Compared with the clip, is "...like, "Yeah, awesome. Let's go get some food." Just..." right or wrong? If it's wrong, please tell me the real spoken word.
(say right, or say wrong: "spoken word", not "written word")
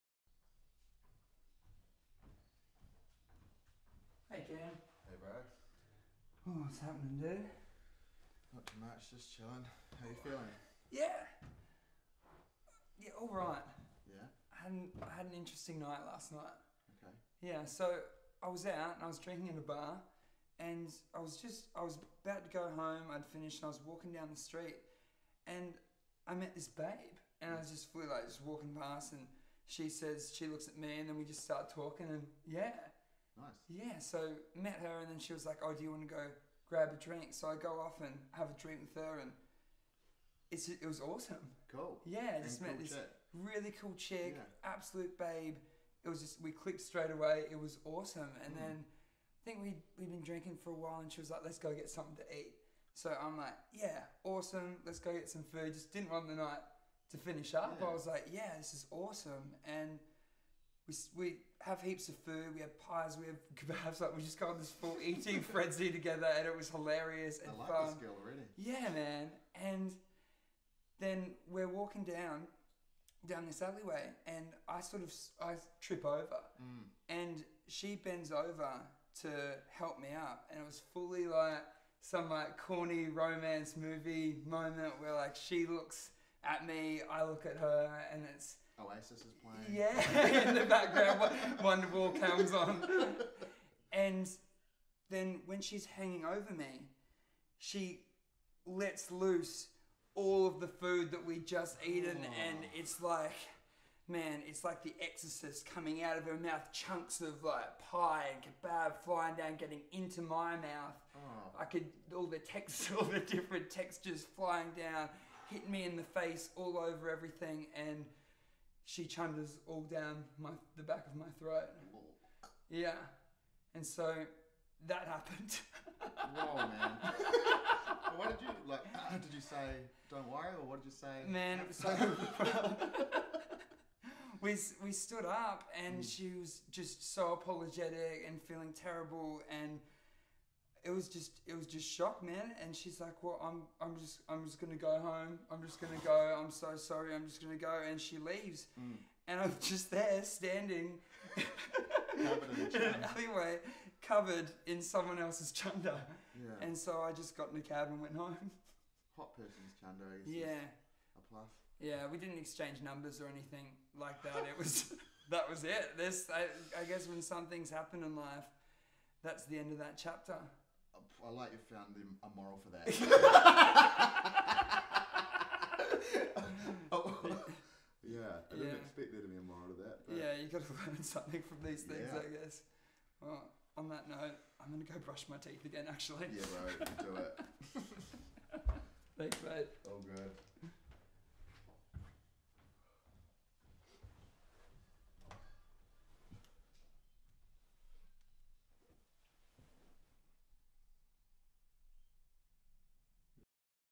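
right.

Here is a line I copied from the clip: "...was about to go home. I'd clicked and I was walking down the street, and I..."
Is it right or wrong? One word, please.
wrong.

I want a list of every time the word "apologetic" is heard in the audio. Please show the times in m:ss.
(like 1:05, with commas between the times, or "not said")
2:17.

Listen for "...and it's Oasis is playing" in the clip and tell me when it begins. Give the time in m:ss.
1:28.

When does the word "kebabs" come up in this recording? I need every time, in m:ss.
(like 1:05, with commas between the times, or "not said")
1:03, 1:48.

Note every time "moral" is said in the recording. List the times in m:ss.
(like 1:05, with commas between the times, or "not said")
2:52, 2:59.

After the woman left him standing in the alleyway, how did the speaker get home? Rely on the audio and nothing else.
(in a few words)
a cab.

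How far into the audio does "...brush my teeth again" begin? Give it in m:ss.
3:04.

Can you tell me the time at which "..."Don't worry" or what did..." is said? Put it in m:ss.
2:10.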